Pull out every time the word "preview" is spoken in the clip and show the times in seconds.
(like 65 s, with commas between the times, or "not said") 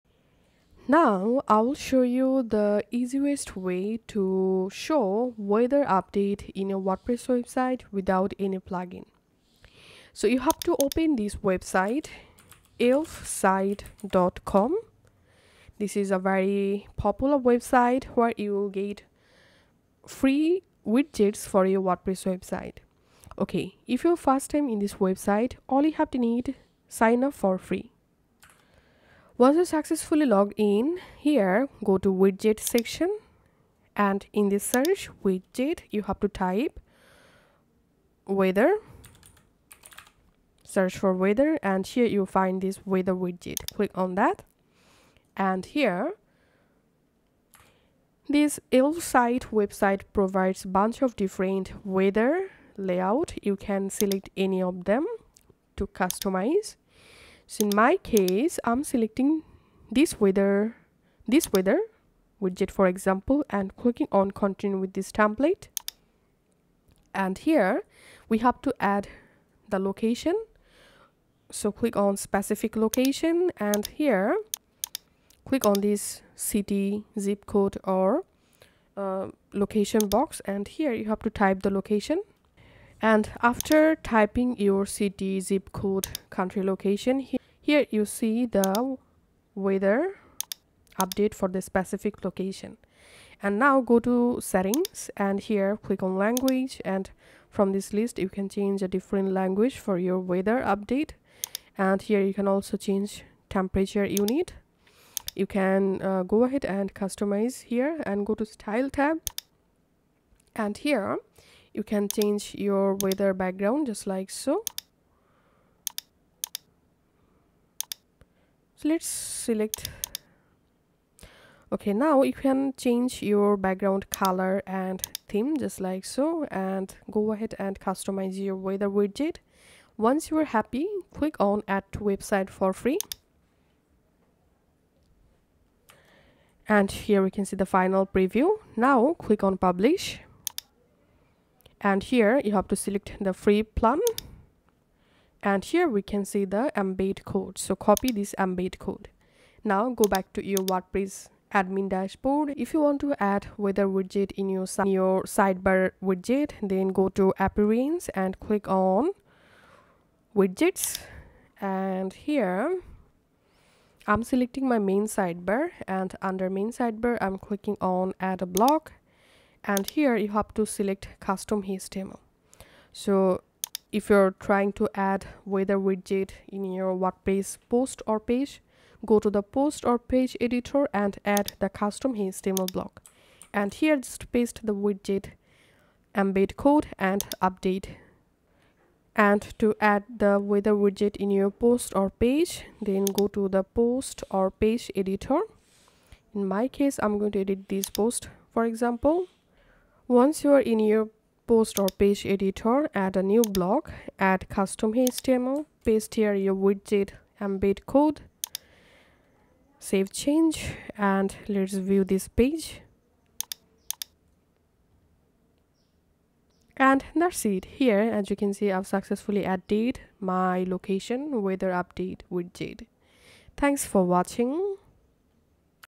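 138 s.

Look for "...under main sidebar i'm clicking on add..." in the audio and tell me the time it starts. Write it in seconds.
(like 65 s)
166 s.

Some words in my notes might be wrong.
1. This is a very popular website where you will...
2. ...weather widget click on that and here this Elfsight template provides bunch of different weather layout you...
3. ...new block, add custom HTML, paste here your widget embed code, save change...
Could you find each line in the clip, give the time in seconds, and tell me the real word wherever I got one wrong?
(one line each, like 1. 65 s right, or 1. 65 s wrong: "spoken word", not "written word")
1. 15 s right
2. 42 s wrong: "website", not "template"
3. 203 s right.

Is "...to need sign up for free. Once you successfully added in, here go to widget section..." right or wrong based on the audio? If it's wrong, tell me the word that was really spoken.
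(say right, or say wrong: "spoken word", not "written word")
wrong: "logged", not "added".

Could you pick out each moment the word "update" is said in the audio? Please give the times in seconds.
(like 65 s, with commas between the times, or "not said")
5 s, 91 s, 100 s, 187 s, 221 s.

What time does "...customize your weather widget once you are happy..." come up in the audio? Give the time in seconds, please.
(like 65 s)
127 s.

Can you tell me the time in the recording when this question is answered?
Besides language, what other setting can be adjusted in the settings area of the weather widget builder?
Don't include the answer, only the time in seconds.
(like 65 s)
103 s.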